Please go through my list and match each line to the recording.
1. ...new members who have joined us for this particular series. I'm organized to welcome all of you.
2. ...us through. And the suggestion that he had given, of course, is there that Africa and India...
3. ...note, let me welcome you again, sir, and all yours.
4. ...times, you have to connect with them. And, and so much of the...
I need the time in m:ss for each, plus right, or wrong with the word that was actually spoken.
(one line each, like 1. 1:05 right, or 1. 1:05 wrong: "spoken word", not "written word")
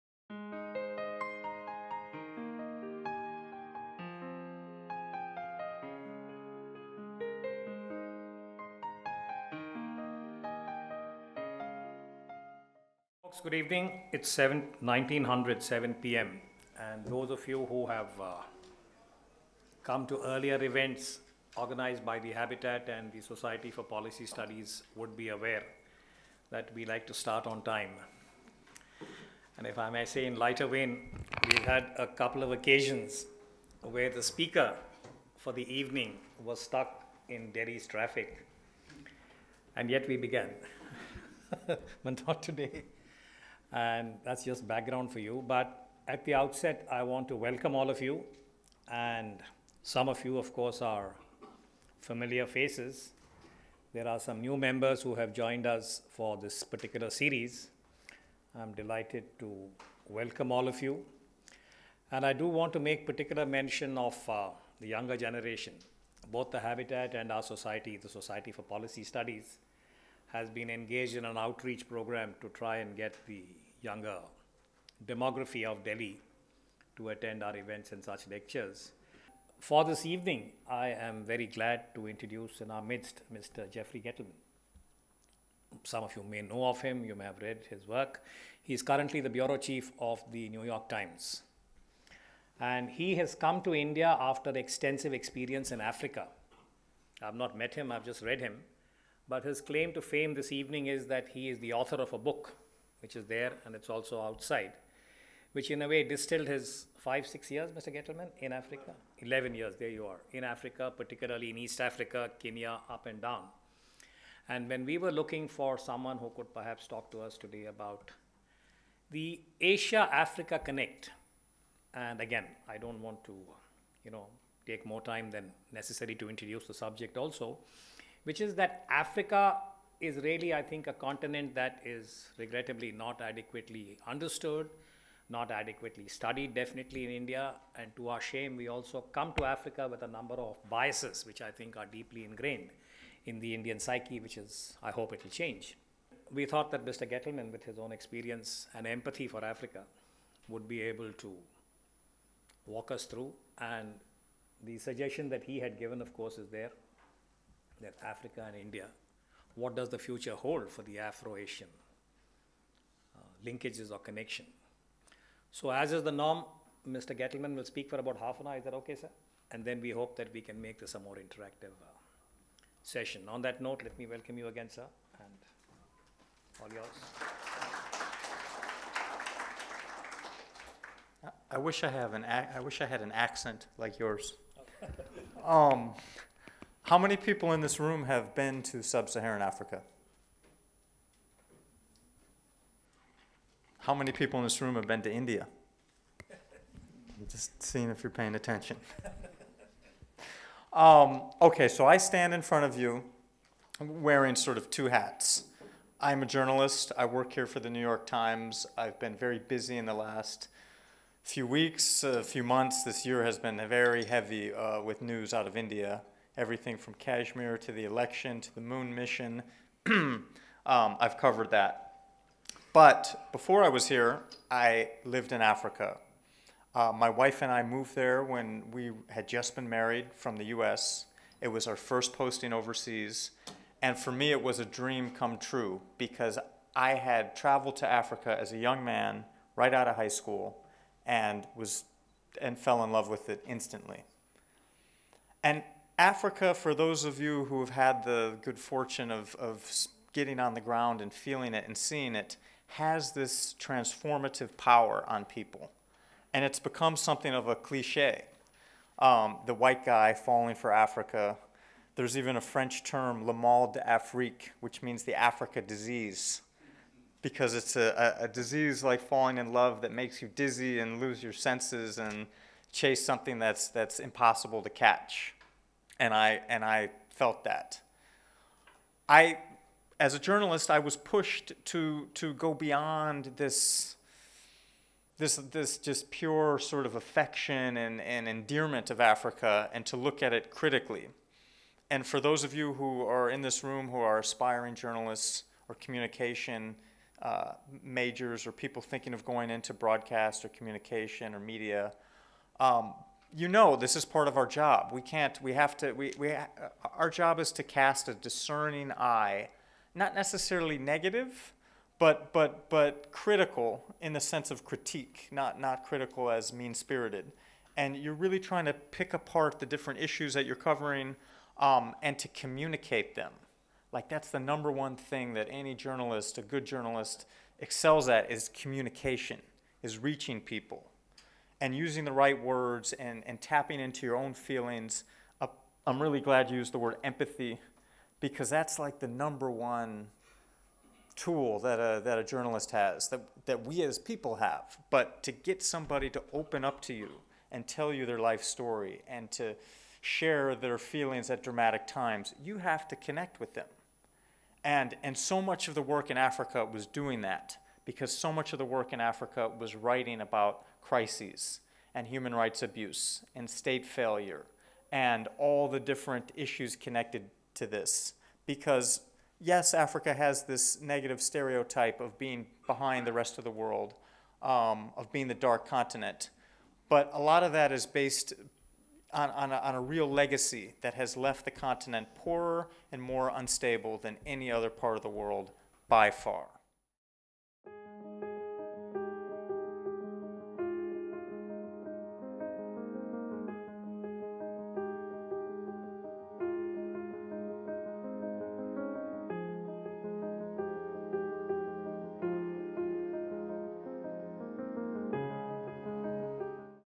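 1. 0:54 wrong: "delighted", not "organized"
2. 2:32 right
3. 2:53 right
4. 5:51 right.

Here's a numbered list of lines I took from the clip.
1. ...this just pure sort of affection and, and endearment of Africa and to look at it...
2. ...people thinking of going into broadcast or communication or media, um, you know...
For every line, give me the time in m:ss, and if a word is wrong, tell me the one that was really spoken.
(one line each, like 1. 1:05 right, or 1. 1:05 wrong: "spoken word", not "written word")
1. 4:45 right
2. 4:58 right.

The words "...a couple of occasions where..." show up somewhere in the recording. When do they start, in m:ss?
0:31.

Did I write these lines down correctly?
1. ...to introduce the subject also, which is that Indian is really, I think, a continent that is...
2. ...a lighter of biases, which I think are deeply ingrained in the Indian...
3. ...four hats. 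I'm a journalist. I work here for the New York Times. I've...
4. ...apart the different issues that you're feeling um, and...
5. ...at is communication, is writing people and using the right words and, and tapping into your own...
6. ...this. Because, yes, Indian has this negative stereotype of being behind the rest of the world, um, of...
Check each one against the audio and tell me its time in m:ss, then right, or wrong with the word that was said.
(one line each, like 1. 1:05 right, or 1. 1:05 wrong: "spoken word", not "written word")
1. 2:06 wrong: "Africa", not "Indian"
2. 2:20 wrong: "number", not "lighter"
3. 3:24 wrong: "two", not "four"
4. 5:19 wrong: "covering", not "feeling"
5. 5:28 wrong: "reaching", not "writing"
6. 6:07 wrong: "Africa", not "Indian".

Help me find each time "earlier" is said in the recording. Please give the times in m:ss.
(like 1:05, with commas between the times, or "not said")
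0:20.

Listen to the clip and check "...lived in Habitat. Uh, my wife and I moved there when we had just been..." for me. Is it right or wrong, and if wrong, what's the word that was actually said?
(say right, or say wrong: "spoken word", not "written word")
wrong: "Africa", not "Habitat".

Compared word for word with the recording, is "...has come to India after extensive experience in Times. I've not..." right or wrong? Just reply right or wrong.
wrong.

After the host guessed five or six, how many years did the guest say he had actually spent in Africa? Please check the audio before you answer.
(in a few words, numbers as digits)
11.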